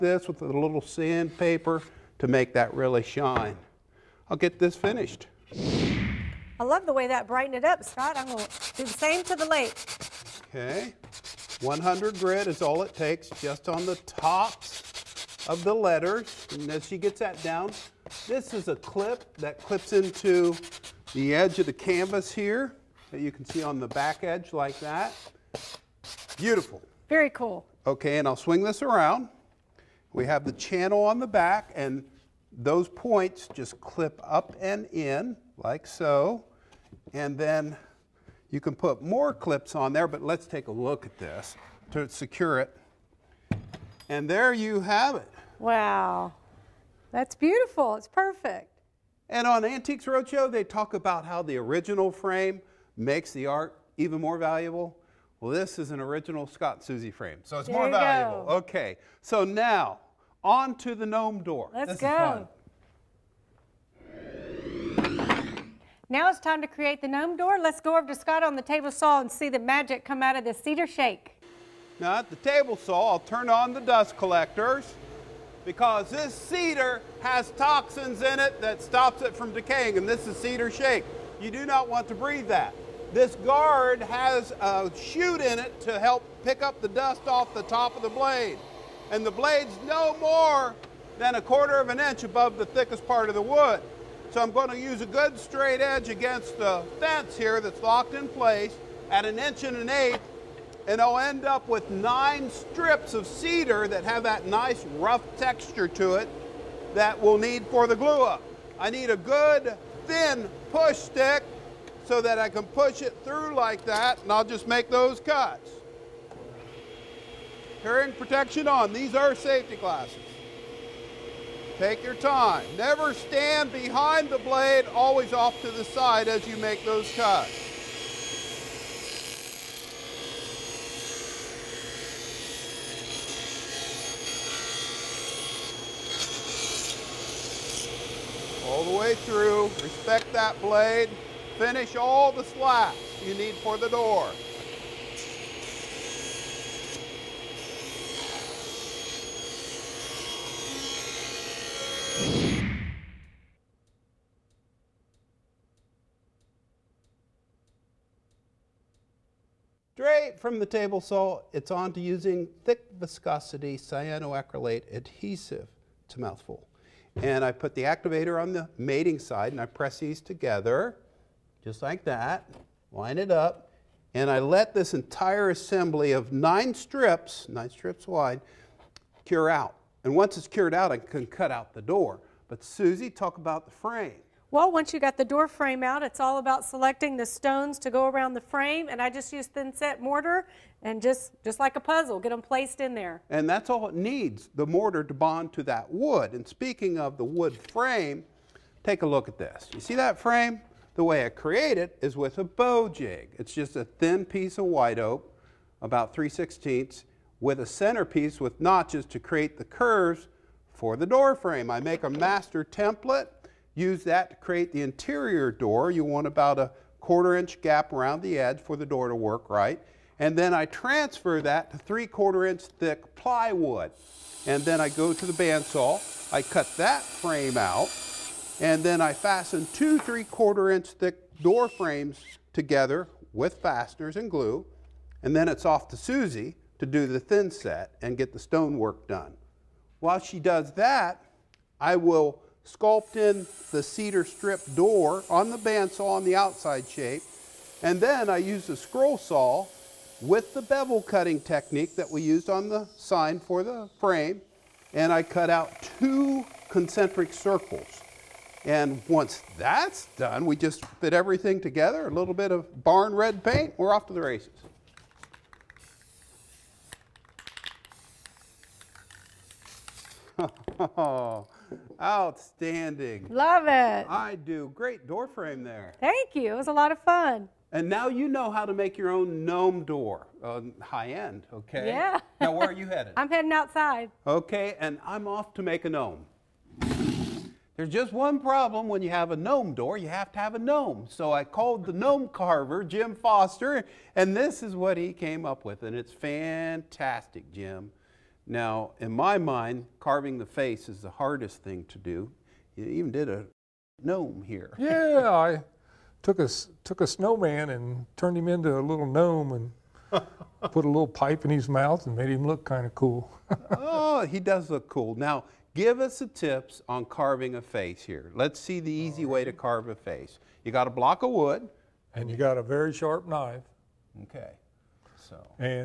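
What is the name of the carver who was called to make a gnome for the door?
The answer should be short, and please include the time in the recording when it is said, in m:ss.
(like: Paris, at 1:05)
Jim Foster, at 4:52.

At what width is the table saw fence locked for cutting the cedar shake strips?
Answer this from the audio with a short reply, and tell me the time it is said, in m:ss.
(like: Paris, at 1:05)
an inch and an eighth, at 1:39.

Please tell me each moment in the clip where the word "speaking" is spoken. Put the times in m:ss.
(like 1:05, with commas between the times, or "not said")
3:16.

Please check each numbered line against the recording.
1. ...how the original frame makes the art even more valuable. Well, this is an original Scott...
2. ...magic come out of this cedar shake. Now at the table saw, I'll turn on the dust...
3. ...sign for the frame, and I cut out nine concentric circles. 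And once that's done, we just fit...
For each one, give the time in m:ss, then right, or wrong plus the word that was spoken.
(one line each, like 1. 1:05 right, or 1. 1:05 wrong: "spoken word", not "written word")
1. 0:51 right
2. 1:09 right
3. 4:12 wrong: "two", not "nine".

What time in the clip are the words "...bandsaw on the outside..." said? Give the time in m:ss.
4:05.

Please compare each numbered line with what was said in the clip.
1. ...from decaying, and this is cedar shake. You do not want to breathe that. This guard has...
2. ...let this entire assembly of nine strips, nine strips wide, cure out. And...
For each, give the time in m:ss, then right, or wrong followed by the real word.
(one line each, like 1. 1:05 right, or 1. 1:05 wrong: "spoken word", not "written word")
1. 1:19 right
2. 2:54 right.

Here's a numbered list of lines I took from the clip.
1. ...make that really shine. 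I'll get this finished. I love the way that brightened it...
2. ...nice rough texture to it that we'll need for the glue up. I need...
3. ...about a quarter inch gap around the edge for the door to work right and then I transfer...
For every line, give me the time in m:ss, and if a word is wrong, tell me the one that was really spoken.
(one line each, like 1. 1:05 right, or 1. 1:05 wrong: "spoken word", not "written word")
1. 0:02 right
2. 1:44 right
3. 3:36 right.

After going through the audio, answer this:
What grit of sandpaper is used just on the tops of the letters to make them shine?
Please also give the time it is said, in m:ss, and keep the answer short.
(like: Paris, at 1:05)
100, at 0:11.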